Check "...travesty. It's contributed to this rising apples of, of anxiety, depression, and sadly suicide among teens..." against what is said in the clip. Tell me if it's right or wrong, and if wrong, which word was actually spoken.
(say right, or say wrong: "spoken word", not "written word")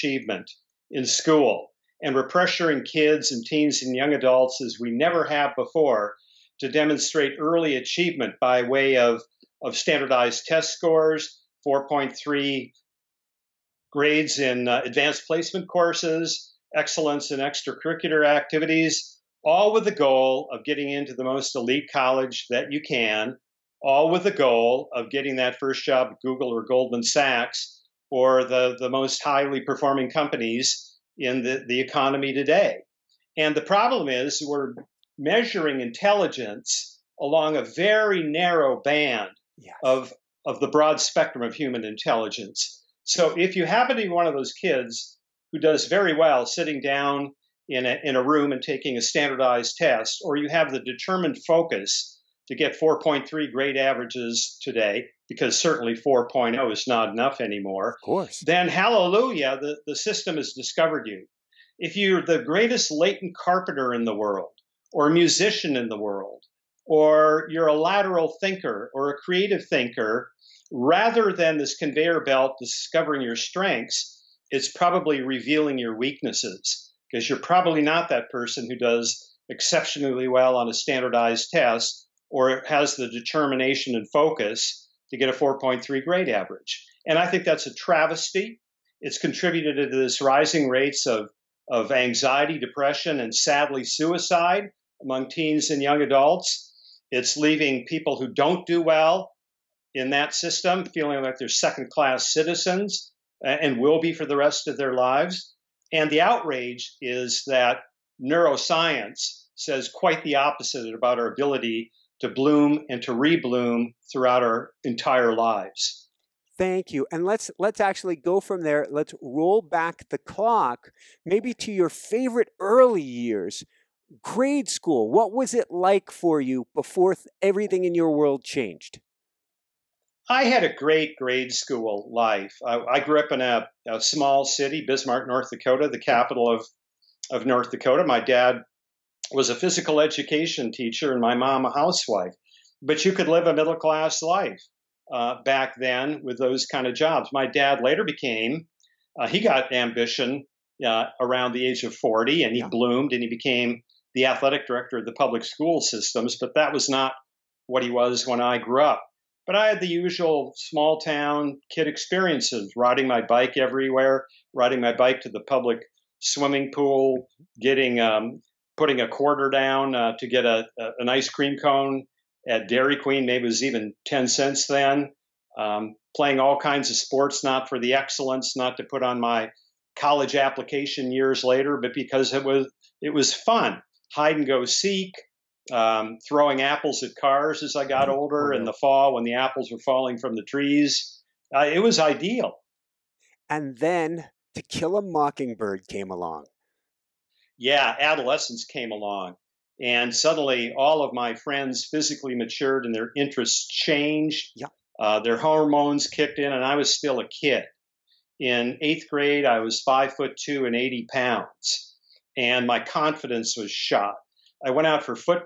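wrong: "rates", not "apples".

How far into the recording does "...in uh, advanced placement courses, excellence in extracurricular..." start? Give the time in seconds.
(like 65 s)
14 s.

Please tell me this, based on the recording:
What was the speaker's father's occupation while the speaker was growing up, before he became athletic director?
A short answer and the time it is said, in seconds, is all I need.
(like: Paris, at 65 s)
physical education teacher, at 139 s.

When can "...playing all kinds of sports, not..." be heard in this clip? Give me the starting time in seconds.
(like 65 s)
176 s.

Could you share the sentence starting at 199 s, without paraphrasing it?
And suddenly, all of my friends physically matured and their interests changed.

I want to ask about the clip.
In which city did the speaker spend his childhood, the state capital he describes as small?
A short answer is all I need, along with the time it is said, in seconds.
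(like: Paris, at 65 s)
Bismarck, at 134 s.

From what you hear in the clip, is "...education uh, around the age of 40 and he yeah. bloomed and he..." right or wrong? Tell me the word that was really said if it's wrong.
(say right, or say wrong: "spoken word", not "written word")
wrong: "ambition", not "education".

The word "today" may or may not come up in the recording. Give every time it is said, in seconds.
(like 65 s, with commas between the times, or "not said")
32 s, 54 s.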